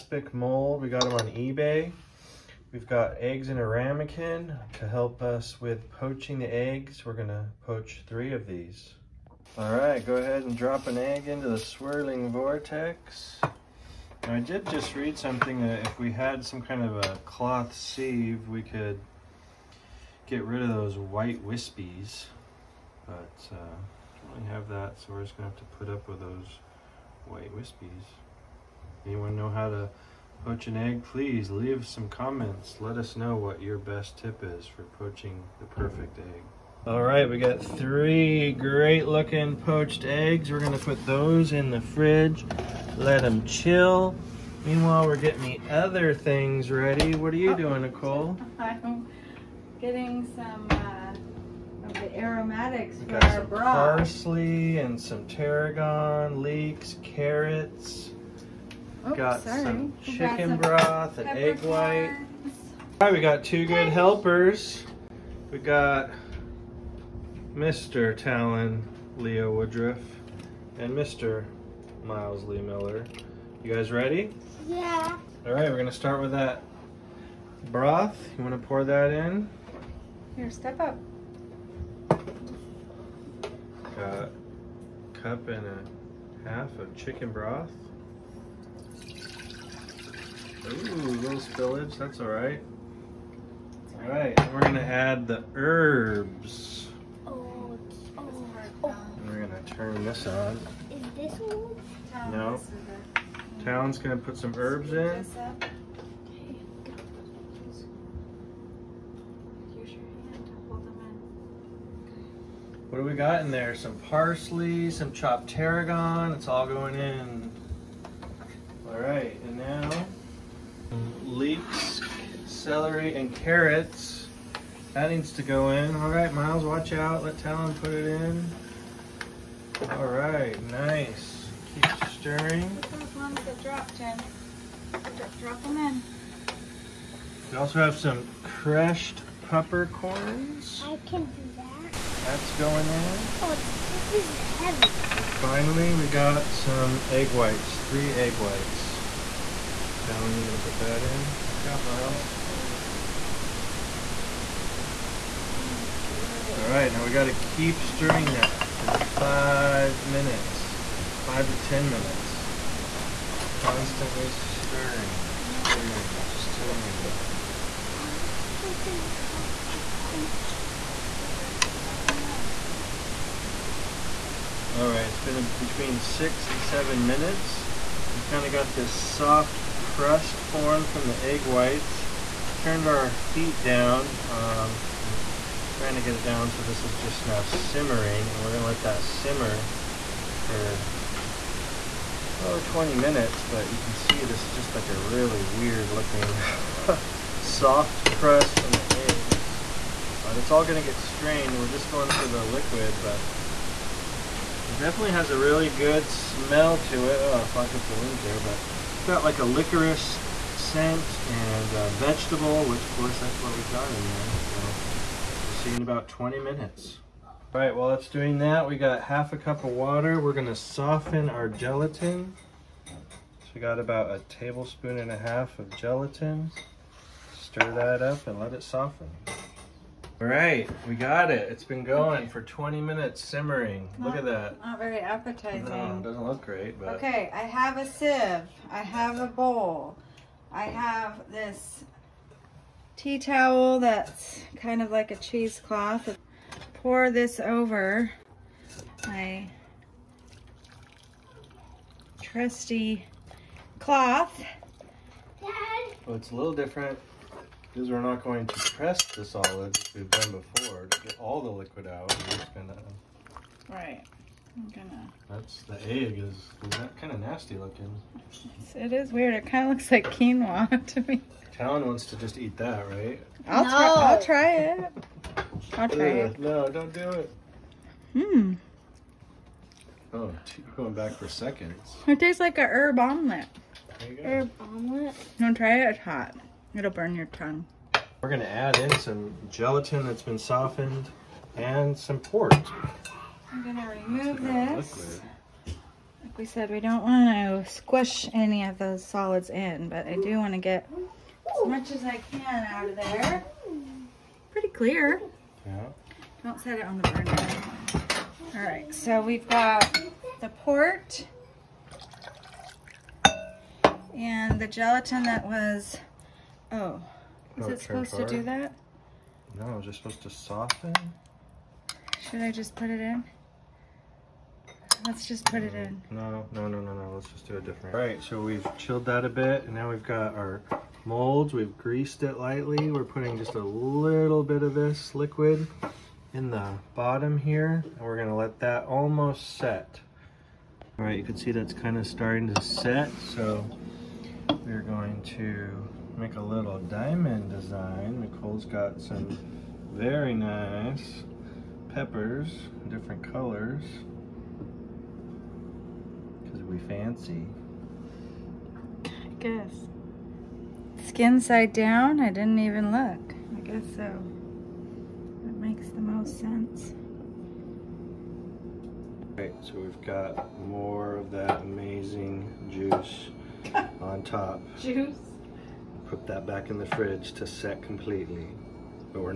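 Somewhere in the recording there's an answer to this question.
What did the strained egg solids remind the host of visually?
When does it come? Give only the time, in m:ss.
4:30.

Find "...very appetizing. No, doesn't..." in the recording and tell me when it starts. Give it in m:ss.
3:54.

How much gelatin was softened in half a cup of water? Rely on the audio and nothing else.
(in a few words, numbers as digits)
1.5 tablespoons.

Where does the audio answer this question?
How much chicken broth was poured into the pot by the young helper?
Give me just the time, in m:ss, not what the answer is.
1:24.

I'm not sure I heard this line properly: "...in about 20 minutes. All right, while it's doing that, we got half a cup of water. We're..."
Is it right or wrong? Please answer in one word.
right.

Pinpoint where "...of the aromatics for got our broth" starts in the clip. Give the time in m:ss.
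0:51.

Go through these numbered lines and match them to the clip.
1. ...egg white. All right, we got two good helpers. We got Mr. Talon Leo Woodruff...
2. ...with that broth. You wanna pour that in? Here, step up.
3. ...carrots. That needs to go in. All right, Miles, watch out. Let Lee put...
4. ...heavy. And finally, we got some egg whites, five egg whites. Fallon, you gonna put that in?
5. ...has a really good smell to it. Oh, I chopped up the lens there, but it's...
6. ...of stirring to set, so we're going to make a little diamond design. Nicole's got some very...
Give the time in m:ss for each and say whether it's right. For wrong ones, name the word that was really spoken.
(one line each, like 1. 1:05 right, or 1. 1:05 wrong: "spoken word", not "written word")
1. 1:01 right
2. 1:16 right
3. 2:03 wrong: "Talon", not "Lee"
4. 2:24 wrong: "three", not "five"
5. 3:25 wrong: "fogged", not "chopped"
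6. 5:41 wrong: "starting", not "stirring".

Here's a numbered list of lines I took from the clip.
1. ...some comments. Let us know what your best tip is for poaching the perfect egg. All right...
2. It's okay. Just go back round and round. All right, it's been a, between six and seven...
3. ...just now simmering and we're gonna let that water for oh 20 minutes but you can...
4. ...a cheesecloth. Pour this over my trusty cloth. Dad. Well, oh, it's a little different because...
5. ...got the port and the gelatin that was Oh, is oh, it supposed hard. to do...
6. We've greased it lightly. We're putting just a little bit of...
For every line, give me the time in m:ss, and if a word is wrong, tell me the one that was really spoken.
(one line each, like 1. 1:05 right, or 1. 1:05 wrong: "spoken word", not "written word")
1. 0:31 right
2. 2:49 right
3. 3:06 wrong: "simmer", not "water"
4. 4:05 right
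5. 5:09 right
6. 5:31 right.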